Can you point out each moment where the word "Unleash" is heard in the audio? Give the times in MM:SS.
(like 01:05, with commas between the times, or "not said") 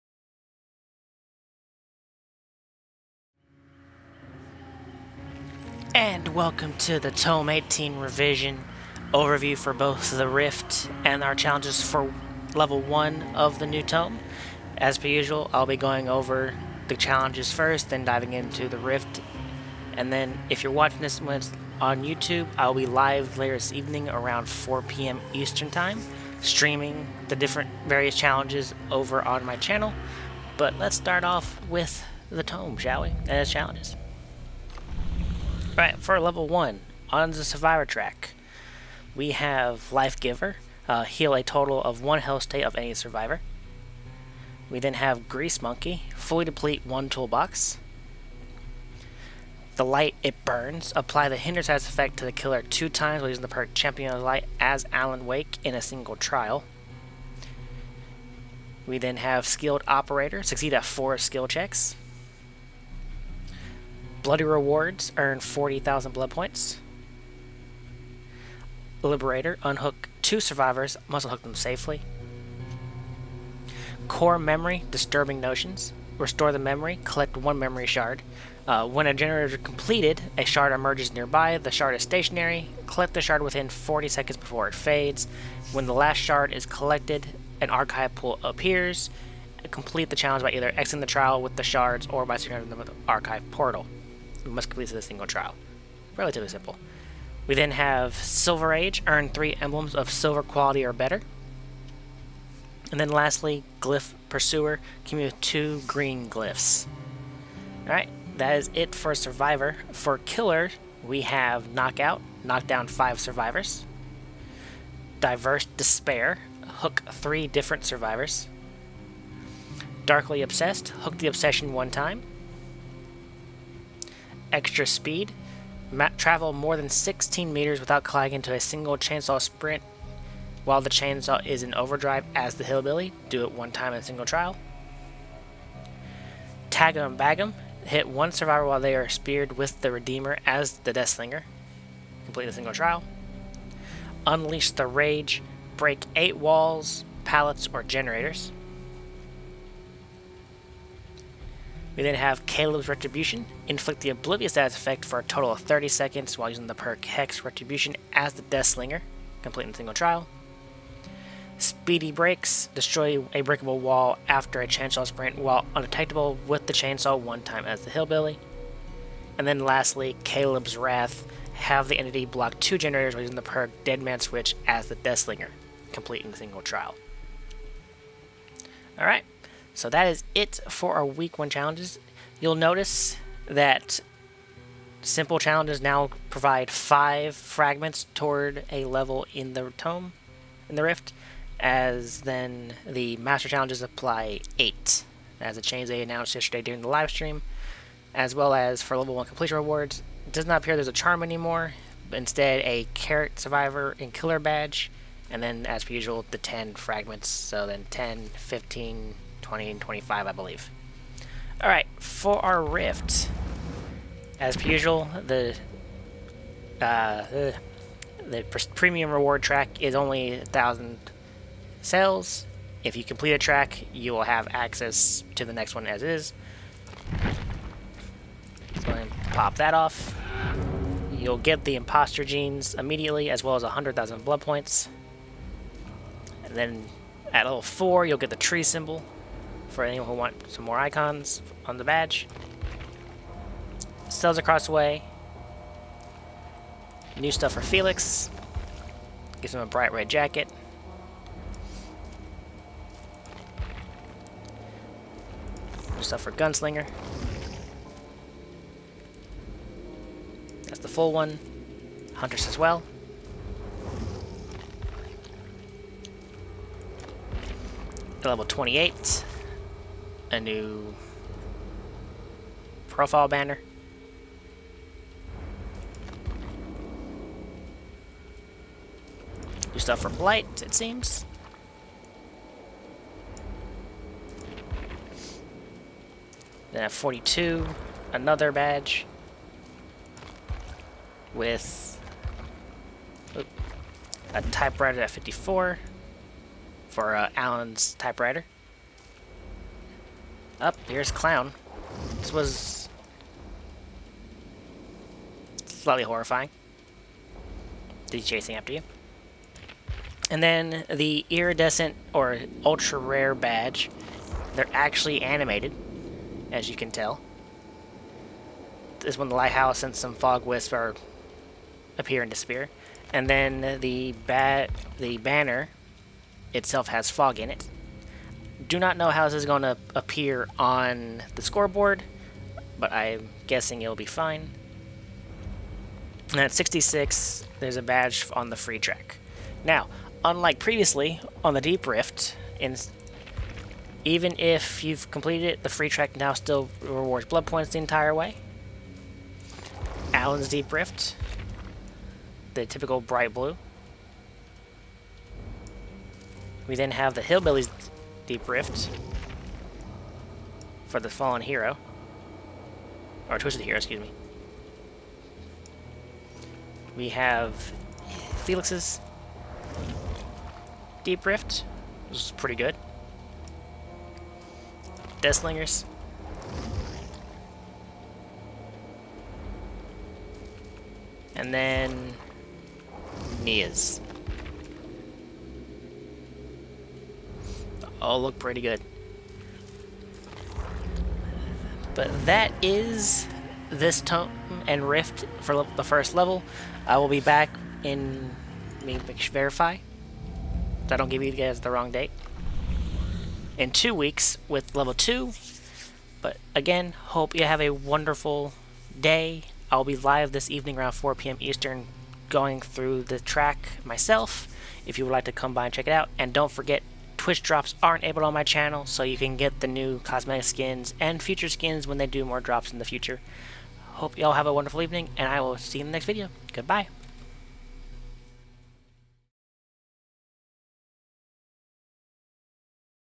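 02:24.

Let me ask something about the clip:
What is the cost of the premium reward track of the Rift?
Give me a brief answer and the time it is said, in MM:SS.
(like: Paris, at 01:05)
1,000 cells, at 03:40.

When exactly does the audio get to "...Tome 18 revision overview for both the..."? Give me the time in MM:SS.
00:07.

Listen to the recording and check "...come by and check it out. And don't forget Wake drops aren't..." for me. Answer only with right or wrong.
wrong.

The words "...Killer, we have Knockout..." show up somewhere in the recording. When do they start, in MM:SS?
01:50.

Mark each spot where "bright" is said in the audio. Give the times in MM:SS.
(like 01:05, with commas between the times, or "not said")
04:09, 05:53.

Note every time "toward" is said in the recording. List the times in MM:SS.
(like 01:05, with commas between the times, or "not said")
03:08.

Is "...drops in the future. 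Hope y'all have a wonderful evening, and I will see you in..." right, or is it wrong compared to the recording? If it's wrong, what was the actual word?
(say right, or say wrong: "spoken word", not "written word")
right.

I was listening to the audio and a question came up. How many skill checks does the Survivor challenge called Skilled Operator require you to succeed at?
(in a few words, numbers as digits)
4.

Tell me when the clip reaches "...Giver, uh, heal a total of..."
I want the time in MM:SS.
00:40.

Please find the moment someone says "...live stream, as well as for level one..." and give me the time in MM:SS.
03:16.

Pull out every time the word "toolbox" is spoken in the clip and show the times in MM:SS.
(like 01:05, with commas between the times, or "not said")
00:47.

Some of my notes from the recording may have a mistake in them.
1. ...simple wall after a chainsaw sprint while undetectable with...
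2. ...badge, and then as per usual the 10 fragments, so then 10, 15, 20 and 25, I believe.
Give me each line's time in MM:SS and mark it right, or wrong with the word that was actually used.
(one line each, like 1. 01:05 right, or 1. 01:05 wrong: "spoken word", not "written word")
1. 02:43 wrong: "breakable", not "simple"
2. 03:24 right.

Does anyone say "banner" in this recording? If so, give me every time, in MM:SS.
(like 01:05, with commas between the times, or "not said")
04:33, 05:25.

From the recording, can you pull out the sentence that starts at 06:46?
But again, hope you have a wonderful day.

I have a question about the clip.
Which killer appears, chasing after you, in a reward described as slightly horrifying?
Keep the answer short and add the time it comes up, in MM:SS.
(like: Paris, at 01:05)
Clown, at 05:01.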